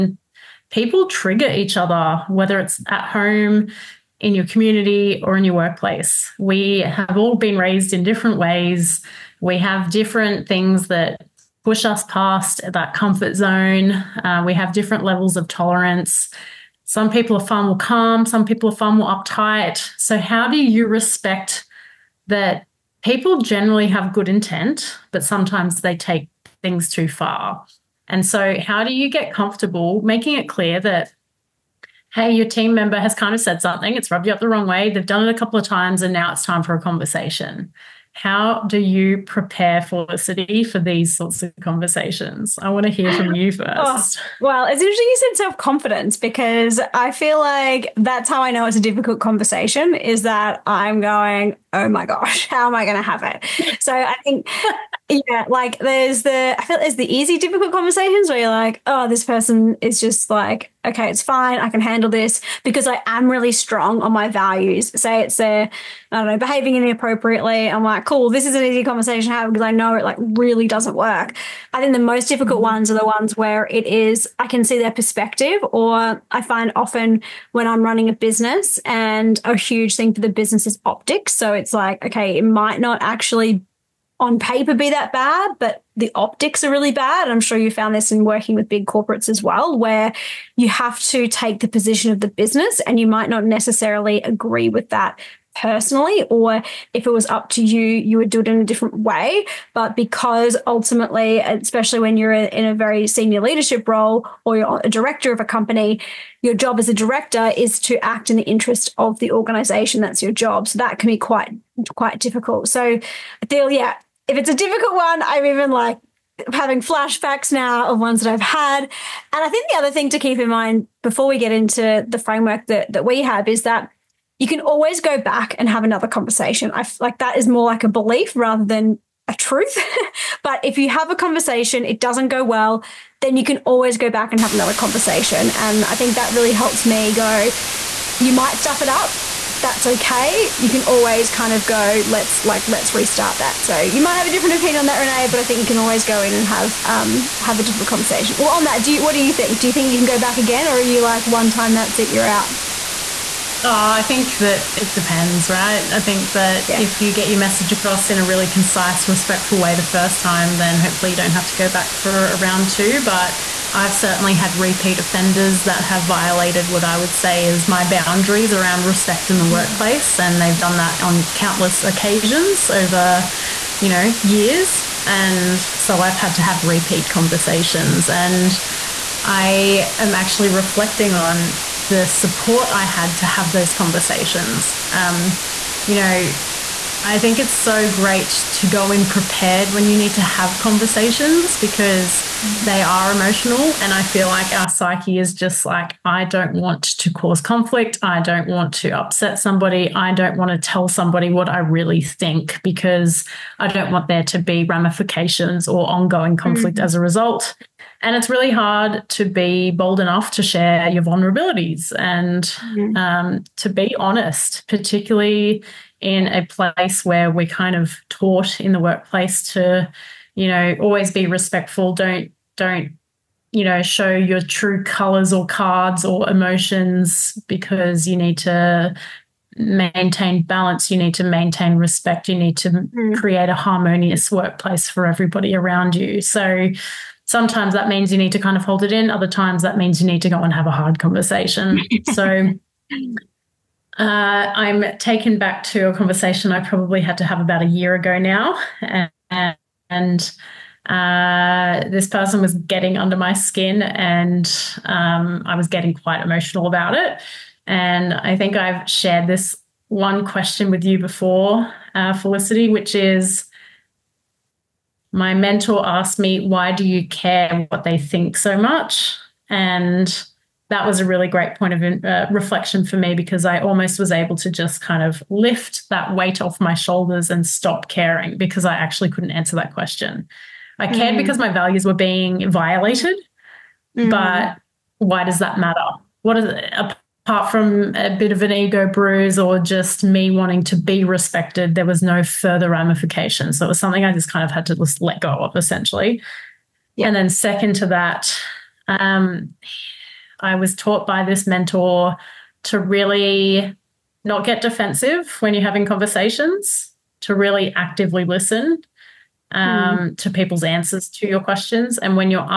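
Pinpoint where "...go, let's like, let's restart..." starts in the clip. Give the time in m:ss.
2:21.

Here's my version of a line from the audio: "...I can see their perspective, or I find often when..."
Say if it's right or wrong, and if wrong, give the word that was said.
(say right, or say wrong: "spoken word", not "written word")
right.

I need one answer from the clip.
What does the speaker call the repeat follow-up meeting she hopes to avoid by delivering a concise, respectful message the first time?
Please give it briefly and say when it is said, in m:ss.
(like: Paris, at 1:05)
round two, at 2:42.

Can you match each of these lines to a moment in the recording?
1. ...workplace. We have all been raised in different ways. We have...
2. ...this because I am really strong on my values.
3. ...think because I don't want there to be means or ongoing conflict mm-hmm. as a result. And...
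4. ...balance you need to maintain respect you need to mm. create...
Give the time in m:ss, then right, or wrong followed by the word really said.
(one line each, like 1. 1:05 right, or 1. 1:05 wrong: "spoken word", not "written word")
1. 0:05 right
2. 1:02 right
3. 3:22 wrong: "ramifications", not "means"
4. 3:50 right.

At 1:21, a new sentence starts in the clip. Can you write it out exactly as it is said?
So it's like, okay, it might not actually on paper be that bad, but the optics are really bad.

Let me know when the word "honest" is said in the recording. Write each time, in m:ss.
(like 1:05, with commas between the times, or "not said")
3:33.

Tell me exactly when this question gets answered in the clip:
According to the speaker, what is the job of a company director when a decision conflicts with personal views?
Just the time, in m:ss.
1:48.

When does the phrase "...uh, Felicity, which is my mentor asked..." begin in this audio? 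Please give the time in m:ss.
4:21.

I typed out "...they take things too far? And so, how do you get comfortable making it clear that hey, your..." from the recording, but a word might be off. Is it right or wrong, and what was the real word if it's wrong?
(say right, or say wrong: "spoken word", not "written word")
right.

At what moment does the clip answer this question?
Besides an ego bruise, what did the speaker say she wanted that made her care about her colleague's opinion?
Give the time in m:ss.
4:50.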